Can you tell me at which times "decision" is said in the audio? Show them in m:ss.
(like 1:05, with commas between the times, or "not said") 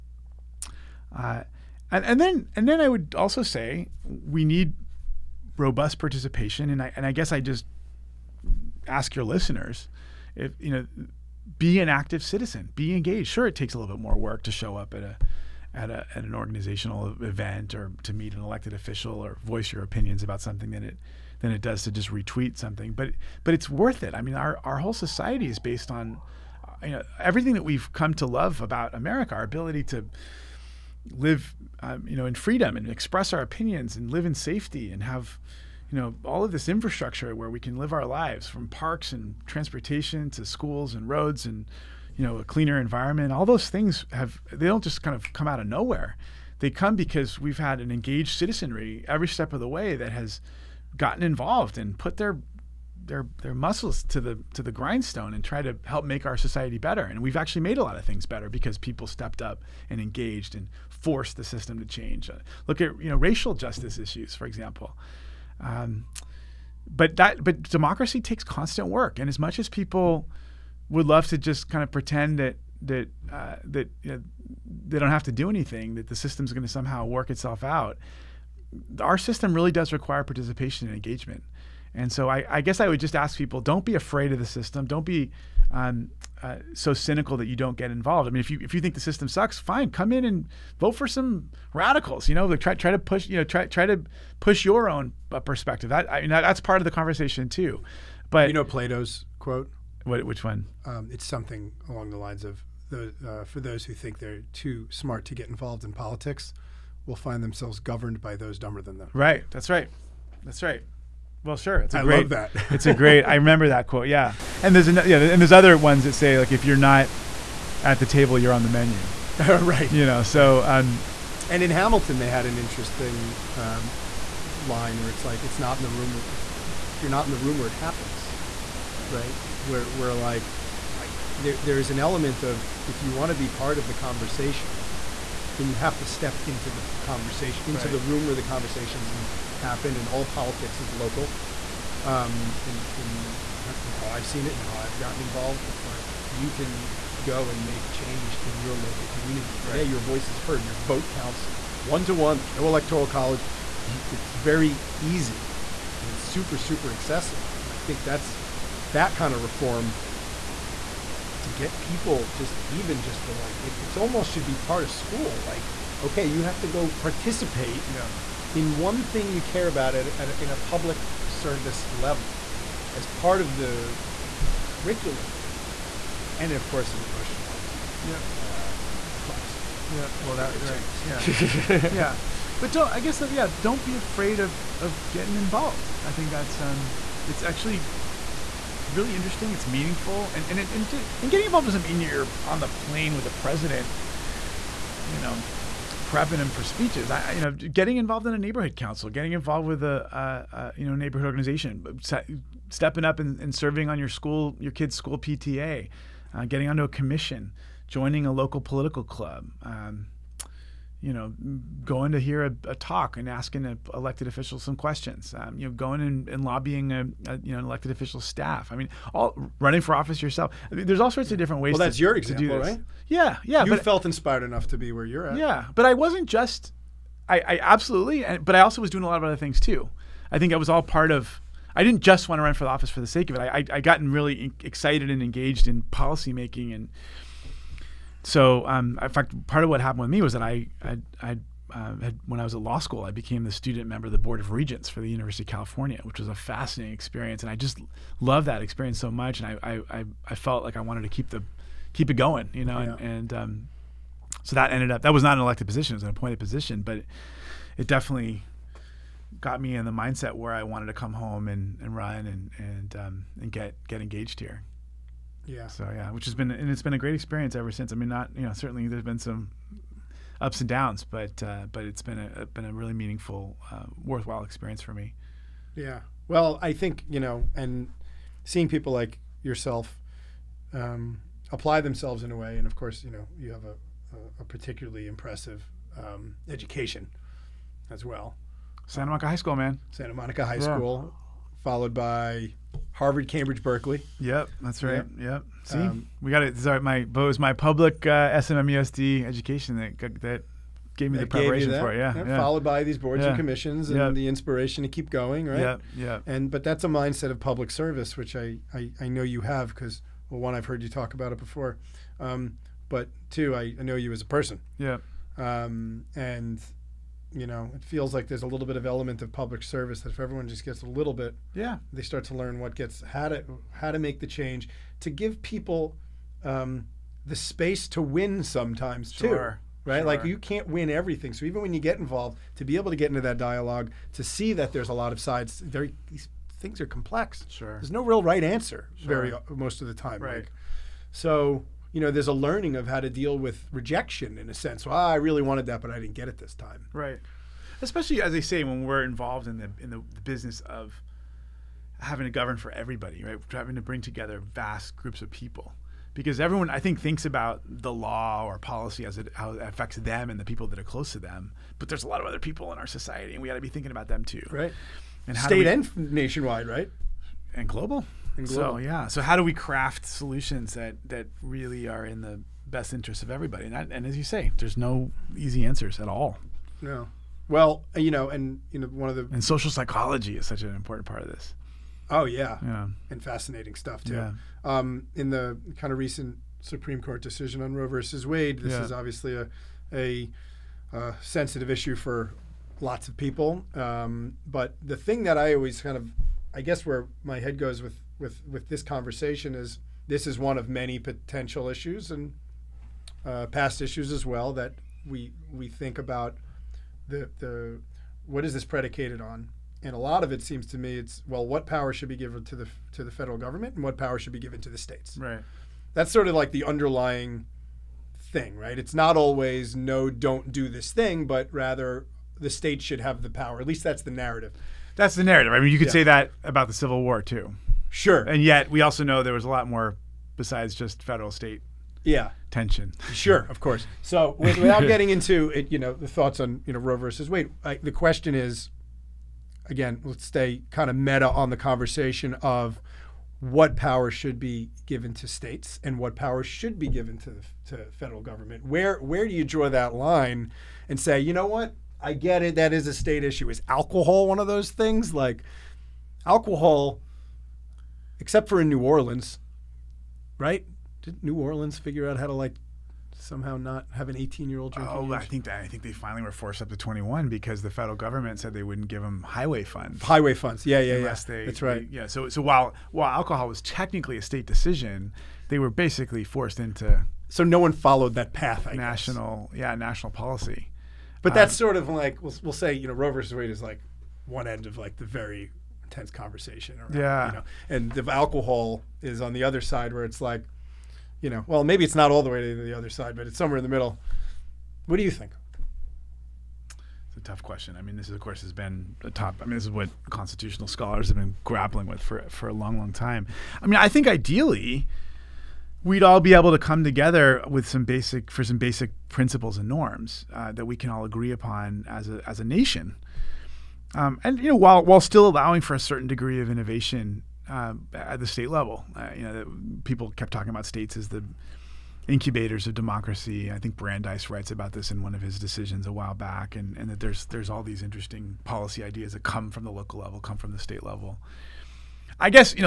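6:27, 7:54, 8:45.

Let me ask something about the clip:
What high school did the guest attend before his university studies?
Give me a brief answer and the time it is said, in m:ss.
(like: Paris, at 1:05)
Santa Monica High School, at 4:48.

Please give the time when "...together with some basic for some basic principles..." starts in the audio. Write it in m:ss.
8:26.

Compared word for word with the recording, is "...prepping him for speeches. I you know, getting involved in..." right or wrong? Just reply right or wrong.
right.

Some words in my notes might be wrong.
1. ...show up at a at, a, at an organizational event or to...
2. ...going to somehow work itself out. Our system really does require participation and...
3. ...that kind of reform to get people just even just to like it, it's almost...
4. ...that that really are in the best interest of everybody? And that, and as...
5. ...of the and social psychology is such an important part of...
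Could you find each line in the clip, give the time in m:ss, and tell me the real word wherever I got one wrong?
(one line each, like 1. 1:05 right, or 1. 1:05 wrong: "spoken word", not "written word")
1. 0:14 right
2. 1:16 right
3. 2:38 right
4. 6:10 right
5. 6:19 right.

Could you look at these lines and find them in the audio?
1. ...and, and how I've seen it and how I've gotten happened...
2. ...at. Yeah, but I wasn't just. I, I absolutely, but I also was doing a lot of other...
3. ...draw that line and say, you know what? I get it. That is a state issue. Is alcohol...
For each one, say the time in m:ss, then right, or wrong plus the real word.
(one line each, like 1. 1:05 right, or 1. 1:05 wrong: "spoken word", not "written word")
1. 2:22 wrong: "involved", not "happened"
2. 3:45 right
3. 7:29 right.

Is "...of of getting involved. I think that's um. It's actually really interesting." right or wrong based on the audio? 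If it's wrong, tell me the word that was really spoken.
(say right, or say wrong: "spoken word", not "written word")
right.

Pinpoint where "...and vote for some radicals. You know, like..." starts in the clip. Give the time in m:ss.
1:30.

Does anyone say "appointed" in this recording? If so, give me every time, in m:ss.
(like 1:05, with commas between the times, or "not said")
4:16.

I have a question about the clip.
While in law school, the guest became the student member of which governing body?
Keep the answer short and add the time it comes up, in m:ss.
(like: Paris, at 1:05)
Board of Regents for the University of California, at 4:04.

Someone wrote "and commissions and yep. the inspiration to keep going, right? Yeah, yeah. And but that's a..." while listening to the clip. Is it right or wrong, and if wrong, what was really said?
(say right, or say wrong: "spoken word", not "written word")
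right.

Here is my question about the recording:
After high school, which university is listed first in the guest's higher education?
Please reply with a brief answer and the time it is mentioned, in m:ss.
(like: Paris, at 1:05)
Harvard, at 4:52.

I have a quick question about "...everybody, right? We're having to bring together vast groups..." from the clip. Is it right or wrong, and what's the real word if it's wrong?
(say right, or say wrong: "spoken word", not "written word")
right.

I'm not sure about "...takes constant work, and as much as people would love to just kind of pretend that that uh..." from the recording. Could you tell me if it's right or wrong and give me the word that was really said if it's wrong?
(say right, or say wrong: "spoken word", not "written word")
right.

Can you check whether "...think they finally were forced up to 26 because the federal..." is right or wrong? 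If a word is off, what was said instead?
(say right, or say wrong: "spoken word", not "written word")
wrong: "21", not "26".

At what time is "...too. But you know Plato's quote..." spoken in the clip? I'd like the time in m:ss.
1:37.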